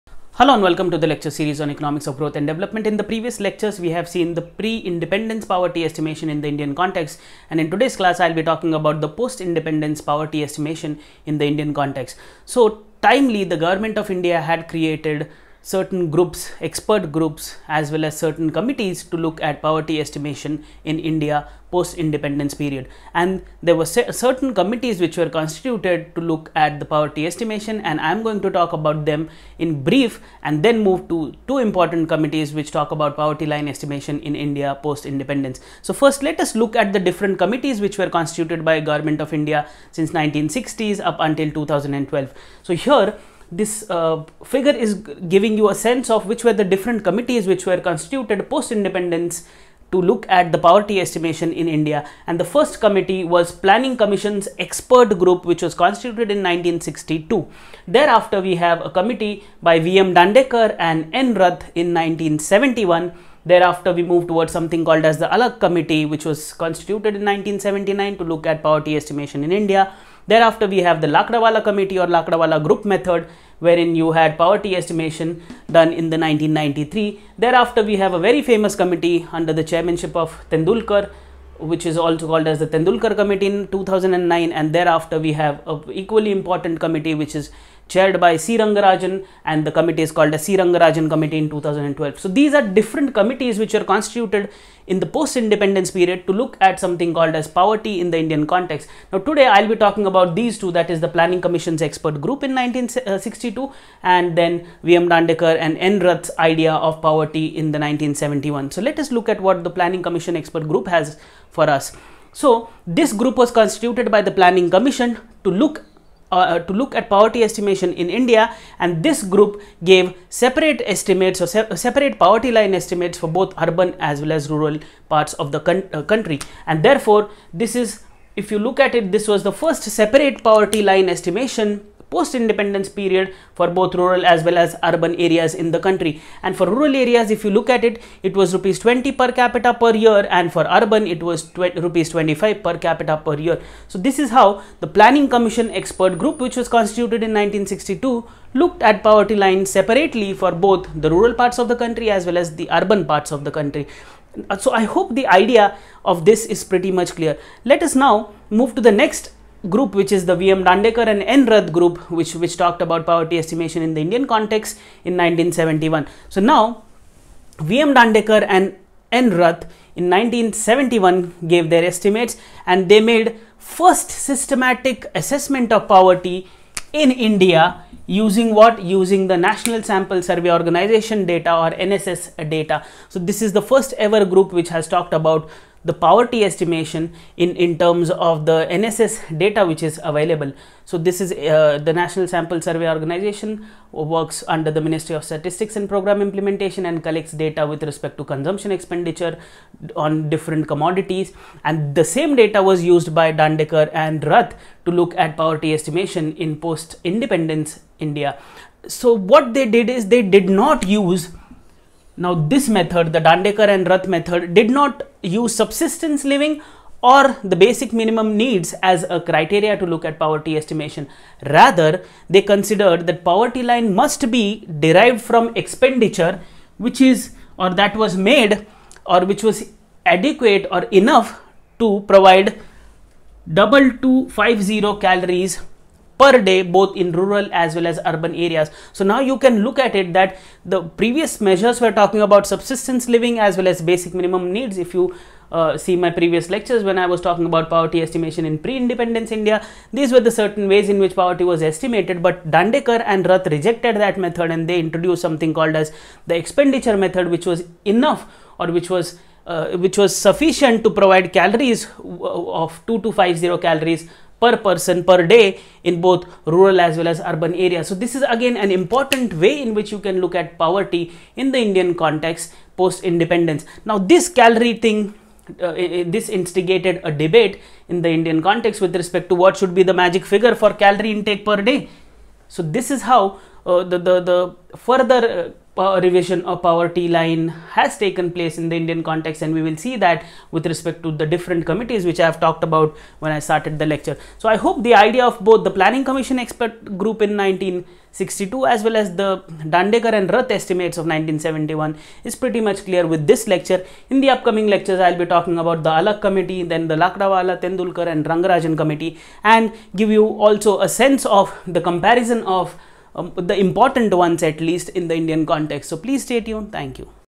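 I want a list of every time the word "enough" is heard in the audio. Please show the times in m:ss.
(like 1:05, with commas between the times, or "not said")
3:51, 4:17.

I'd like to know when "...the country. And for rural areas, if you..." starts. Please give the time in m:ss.
2:15.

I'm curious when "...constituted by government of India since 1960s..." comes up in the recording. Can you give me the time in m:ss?
0:38.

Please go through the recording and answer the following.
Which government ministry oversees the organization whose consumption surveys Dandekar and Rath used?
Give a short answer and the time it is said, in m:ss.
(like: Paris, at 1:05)
Ministry of Statistics and Program Implementation, at 3:14.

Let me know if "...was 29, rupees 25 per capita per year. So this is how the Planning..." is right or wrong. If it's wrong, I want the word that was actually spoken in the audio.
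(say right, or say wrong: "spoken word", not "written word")
wrong: "20", not "29".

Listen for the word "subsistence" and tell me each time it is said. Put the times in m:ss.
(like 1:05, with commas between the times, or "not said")
3:35, 4:02.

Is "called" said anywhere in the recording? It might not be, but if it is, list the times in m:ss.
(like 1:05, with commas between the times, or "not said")
1:04, 1:22, 1:30, 1:37, 4:15.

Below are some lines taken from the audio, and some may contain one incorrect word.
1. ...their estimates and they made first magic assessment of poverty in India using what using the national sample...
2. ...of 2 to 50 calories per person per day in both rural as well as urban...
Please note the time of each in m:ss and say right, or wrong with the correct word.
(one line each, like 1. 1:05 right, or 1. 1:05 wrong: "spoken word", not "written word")
1. 2:51 wrong: "systematic", not "magic"
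2. 4:22 right.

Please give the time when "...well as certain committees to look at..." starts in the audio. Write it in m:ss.
0:17.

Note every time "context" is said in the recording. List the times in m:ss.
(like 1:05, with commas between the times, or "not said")
0:06, 0:11, 1:38, 2:44, 4:32, 4:38, 4:49, 5:15.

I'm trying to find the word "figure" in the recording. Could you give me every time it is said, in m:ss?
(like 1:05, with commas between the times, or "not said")
0:44, 4:40.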